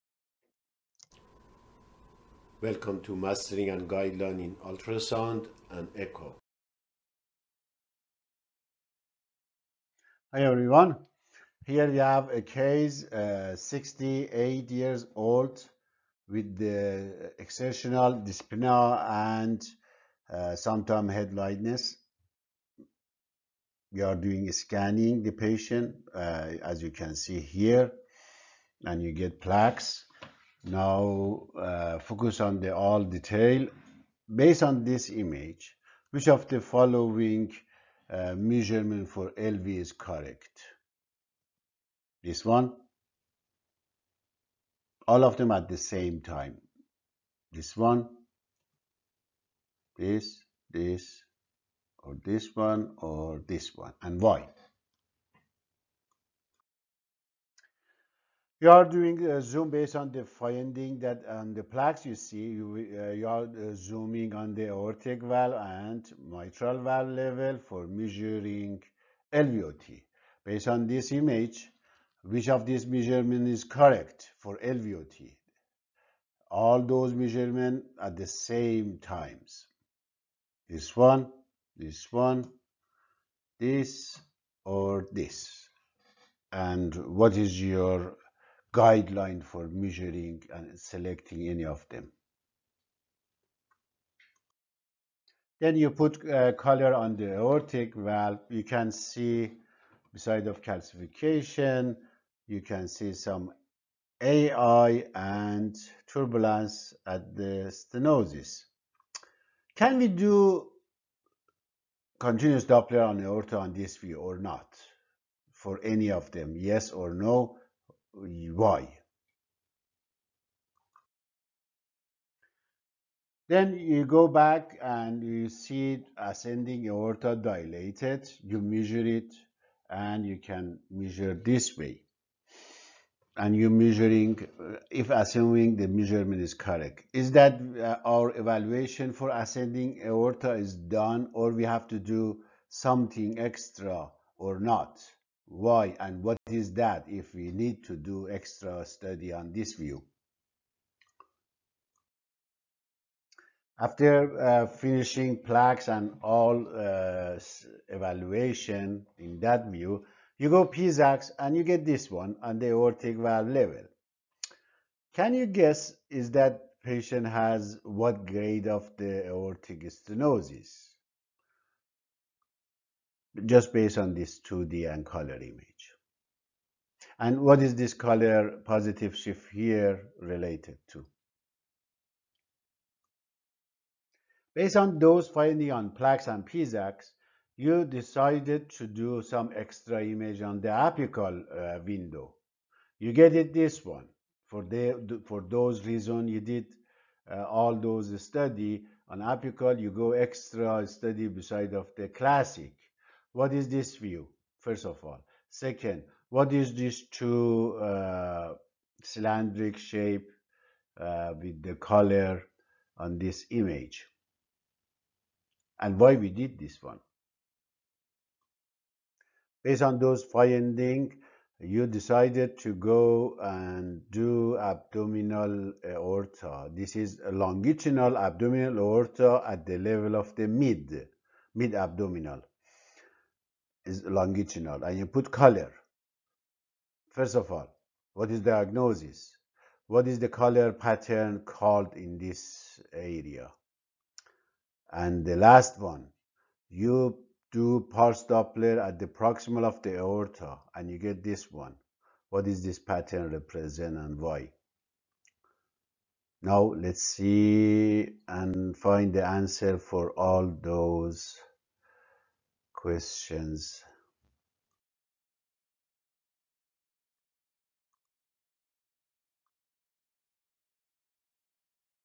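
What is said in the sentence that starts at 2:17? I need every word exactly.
Is that uh, our evaluation for ascending aorta is done or we have to do something extra or not?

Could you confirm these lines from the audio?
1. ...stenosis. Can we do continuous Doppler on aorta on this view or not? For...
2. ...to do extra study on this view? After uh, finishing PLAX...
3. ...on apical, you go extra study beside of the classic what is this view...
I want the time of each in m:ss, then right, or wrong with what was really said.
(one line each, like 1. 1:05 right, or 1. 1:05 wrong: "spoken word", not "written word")
1. 1:47 right
2. 2:27 right
3. 3:19 right.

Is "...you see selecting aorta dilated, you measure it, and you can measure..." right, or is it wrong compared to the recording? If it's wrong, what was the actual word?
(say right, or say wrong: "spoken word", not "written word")
wrong: "ascending", not "selecting".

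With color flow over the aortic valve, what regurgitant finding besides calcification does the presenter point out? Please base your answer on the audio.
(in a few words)
AI.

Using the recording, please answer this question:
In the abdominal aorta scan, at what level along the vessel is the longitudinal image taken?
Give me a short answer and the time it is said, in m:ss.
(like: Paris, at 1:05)
mid abdominal, at 3:51.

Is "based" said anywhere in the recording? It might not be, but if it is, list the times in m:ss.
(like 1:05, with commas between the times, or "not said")
0:34, 0:59, 1:10, 2:53, 3:04, 3:39.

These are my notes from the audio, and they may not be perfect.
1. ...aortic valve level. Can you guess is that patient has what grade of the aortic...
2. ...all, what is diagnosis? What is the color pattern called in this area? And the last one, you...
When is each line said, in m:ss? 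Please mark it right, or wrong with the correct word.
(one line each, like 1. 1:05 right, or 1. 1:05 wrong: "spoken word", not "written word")
1. 2:42 right
2. 3:57 right.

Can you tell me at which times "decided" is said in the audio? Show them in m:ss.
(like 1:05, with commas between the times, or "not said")
3:07, 3:41.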